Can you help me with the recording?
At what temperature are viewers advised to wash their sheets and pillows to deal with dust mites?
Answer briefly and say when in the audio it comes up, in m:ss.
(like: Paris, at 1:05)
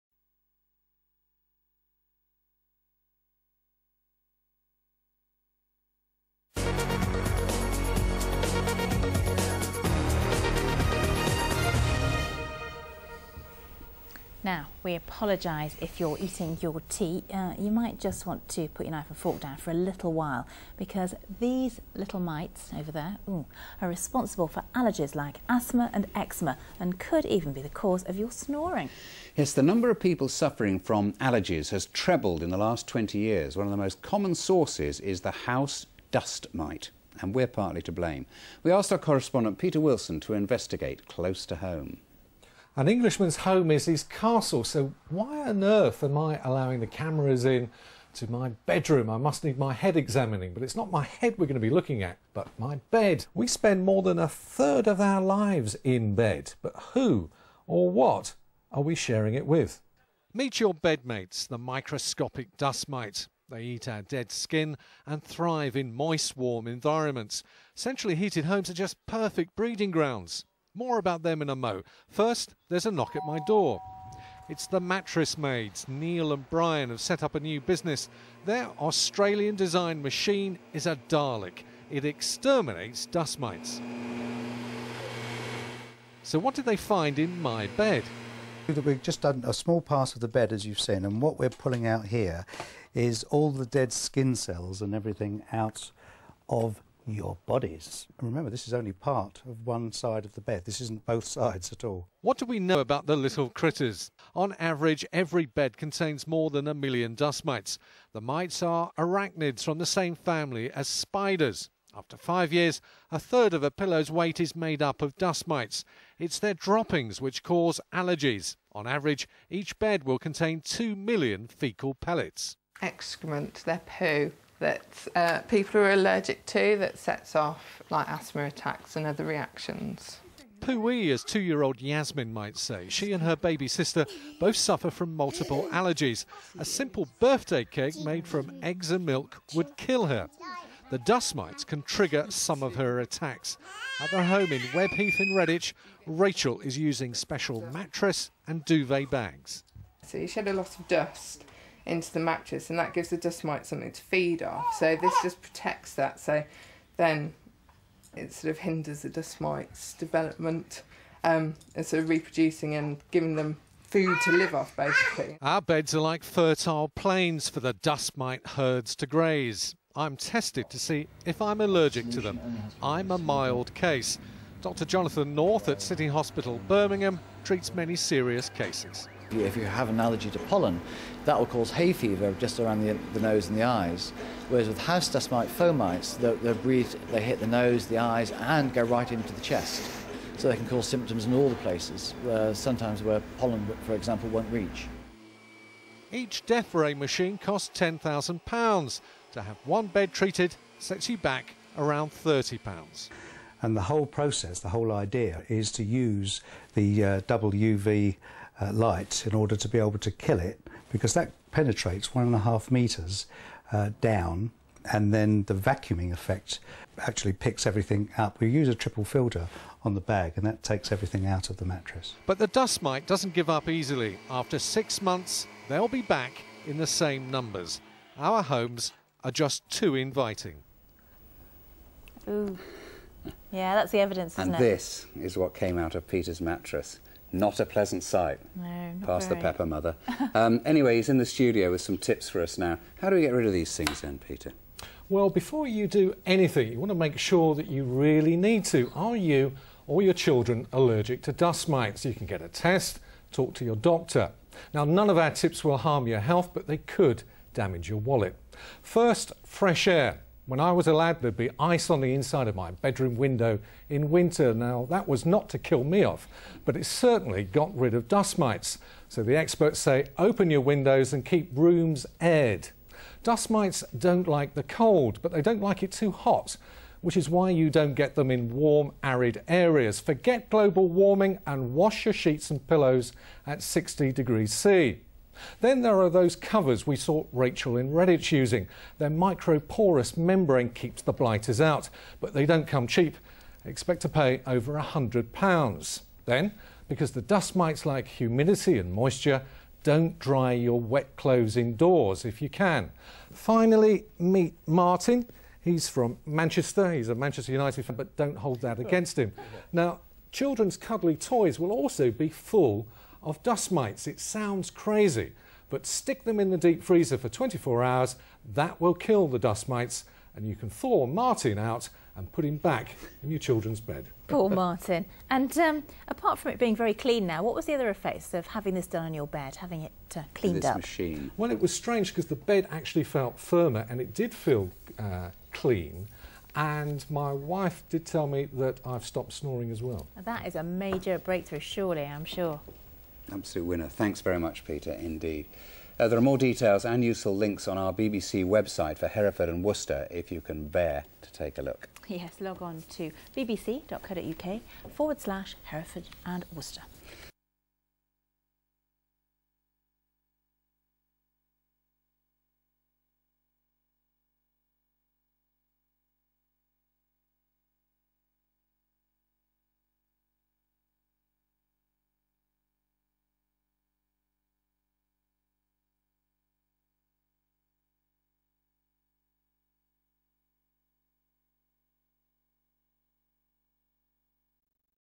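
60 degrees C, at 4:43.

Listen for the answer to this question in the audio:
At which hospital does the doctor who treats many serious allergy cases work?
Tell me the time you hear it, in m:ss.
2:55.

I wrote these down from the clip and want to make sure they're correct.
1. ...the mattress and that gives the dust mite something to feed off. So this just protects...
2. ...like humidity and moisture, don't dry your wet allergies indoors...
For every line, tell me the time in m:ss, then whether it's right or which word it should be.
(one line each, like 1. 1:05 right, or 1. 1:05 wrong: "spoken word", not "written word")
1. 2:32 right
2. 4:57 wrong: "clothes", not "allergies".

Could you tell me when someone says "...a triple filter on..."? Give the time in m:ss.
3:38.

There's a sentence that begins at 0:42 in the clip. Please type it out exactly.
An Englishman's home is his castle, so why on earth am I allowing the cameras in to my bedroom?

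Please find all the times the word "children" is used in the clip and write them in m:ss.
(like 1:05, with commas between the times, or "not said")
4:10, 5:10, 5:23.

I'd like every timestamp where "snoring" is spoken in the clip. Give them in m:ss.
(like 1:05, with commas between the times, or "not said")
0:28, 5:39.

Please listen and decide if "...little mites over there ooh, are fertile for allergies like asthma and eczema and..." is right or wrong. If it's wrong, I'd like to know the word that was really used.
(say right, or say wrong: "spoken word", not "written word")
wrong: "responsible", not "fertile".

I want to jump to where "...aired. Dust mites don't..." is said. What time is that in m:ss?
4:32.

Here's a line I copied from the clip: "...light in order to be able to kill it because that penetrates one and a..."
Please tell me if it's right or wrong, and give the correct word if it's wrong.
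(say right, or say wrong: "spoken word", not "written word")
right.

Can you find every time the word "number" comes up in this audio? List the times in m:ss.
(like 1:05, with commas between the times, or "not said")
0:29, 3:47.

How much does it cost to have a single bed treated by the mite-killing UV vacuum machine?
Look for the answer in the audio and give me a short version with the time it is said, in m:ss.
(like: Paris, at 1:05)
£30, at 3:22.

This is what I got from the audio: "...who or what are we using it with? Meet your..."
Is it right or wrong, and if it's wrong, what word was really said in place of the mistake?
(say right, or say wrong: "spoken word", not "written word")
wrong: "sharing", not "using".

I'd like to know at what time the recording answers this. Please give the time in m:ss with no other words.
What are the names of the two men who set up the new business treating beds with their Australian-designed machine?
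1:15.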